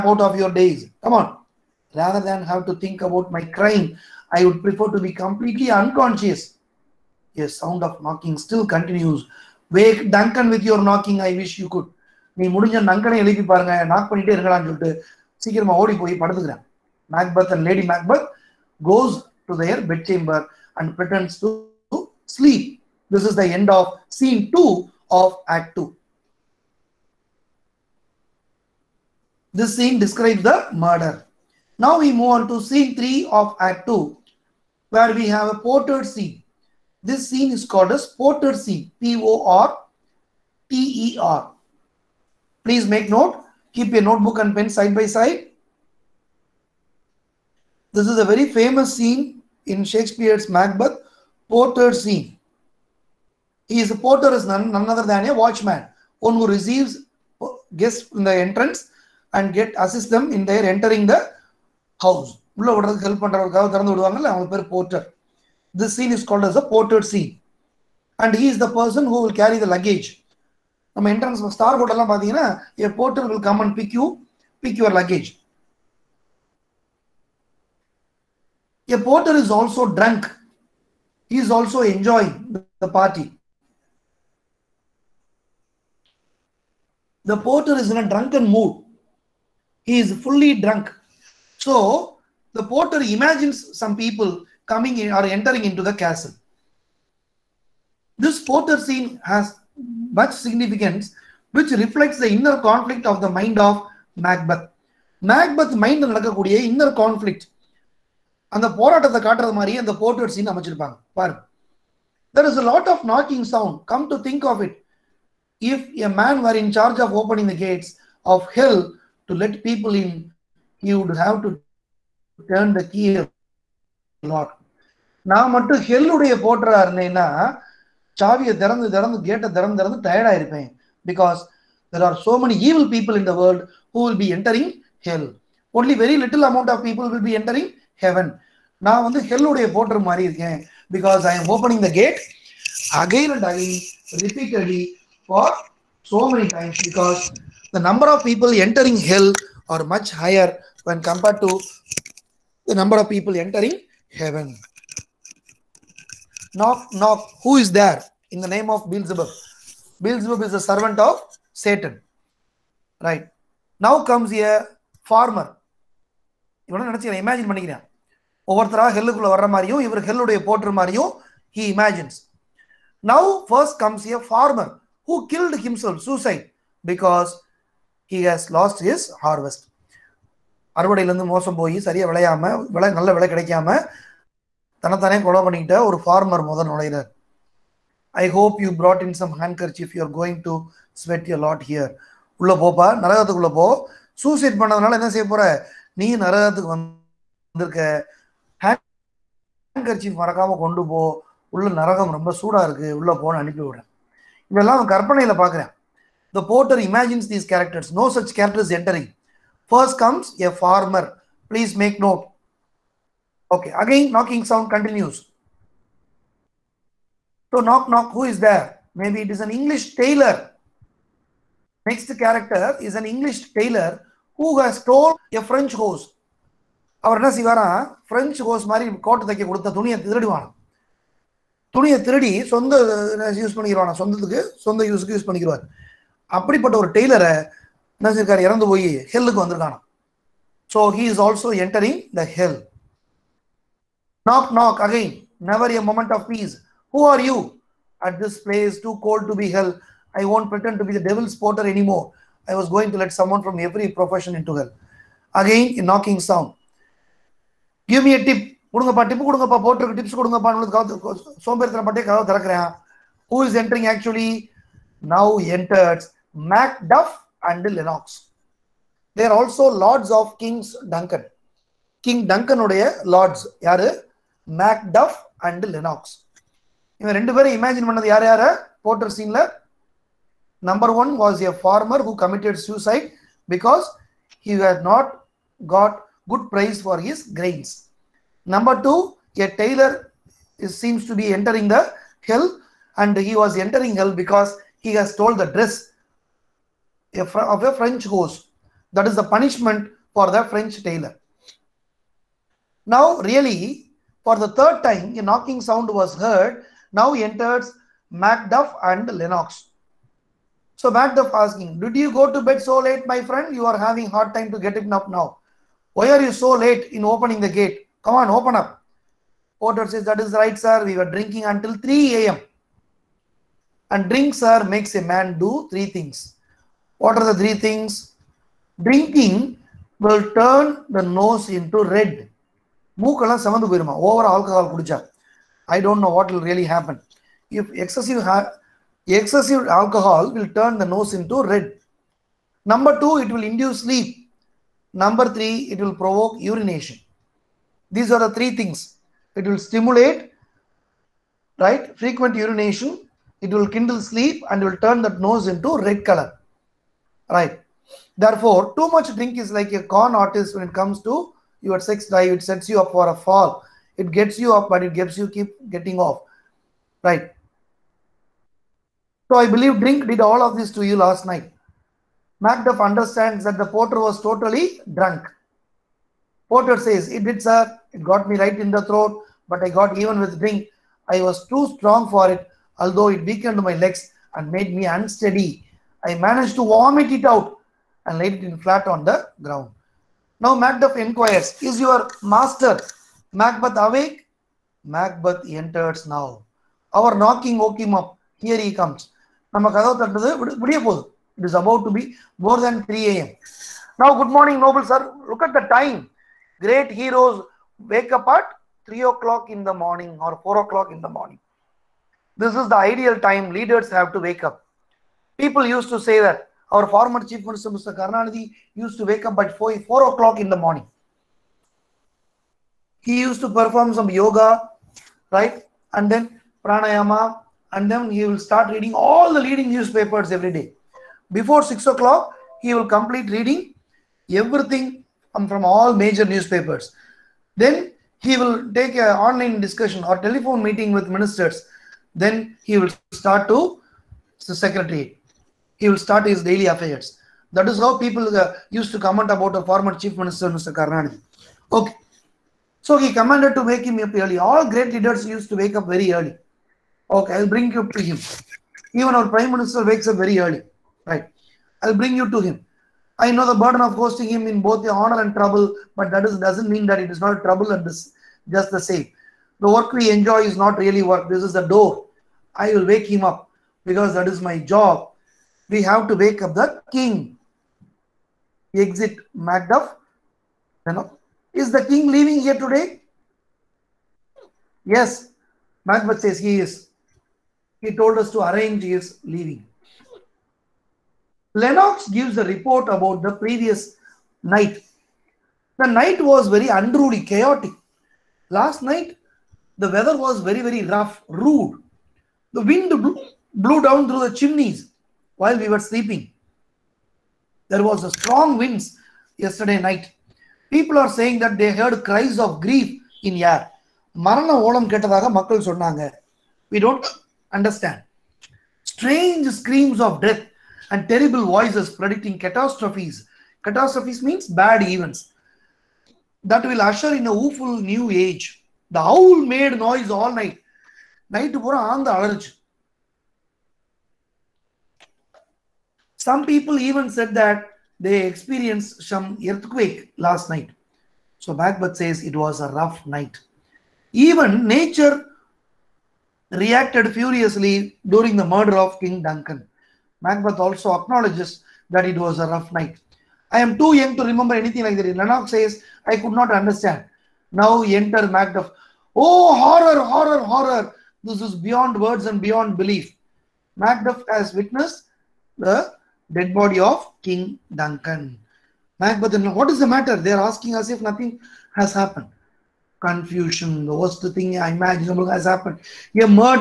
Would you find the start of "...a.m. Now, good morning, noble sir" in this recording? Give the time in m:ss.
6:43.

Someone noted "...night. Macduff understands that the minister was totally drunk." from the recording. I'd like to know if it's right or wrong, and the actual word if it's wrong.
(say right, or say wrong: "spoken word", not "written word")
wrong: "porter", not "minister".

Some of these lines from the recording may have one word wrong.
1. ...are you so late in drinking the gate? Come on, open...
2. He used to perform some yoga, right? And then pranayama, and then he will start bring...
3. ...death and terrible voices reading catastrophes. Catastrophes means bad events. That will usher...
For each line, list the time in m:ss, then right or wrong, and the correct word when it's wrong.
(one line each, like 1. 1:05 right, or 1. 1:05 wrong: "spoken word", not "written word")
1. 5:16 wrong: "opening", not "drinking"
2. 7:03 wrong: "reading", not "bring"
3. 8:40 wrong: "predicting", not "reading".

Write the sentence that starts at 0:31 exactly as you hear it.
Now we move on to scene 3 of Act 2, where we have a porter scene.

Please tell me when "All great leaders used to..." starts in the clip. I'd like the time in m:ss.
7:34.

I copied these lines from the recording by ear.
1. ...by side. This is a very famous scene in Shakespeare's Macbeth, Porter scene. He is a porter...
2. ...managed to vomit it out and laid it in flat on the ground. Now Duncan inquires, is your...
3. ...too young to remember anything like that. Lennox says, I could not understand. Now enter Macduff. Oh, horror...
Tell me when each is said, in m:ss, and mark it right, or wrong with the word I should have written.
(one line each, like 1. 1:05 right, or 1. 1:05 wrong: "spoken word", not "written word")
1. 0:44 right
2. 6:26 wrong: "Macduff", not "Duncan"
3. 9:13 right.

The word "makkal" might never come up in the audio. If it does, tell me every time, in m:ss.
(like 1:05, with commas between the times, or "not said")
8:35.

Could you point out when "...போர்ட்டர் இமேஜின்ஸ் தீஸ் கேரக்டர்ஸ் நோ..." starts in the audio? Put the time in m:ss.
3:26.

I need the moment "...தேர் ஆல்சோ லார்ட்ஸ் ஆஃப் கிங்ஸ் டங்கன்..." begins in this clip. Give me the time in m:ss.
4:29.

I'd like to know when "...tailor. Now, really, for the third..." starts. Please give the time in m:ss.
5:00.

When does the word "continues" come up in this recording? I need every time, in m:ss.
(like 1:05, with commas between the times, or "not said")
0:08, 3:34.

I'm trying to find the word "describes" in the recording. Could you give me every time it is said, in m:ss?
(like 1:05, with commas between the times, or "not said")
0:30.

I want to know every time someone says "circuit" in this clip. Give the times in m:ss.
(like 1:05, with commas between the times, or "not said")
not said.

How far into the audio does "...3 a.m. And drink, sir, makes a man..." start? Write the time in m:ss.
5:21.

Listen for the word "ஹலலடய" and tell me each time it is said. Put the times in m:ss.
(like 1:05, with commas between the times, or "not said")
2:05, 2:19, 2:50.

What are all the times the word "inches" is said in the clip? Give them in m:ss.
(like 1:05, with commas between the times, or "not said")
not said.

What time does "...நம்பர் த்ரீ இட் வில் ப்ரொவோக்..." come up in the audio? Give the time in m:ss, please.
5:45.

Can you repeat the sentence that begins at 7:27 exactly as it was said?
That is how people uh, used to comment about the former chief minister, Mr.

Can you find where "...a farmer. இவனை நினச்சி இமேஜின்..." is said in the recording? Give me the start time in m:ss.
2:44.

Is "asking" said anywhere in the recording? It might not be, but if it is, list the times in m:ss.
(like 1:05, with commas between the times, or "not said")
5:11, 9:30.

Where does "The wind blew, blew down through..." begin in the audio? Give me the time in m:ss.
8:22.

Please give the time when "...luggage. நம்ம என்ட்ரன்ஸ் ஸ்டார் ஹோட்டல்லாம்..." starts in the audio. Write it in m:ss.
1:09.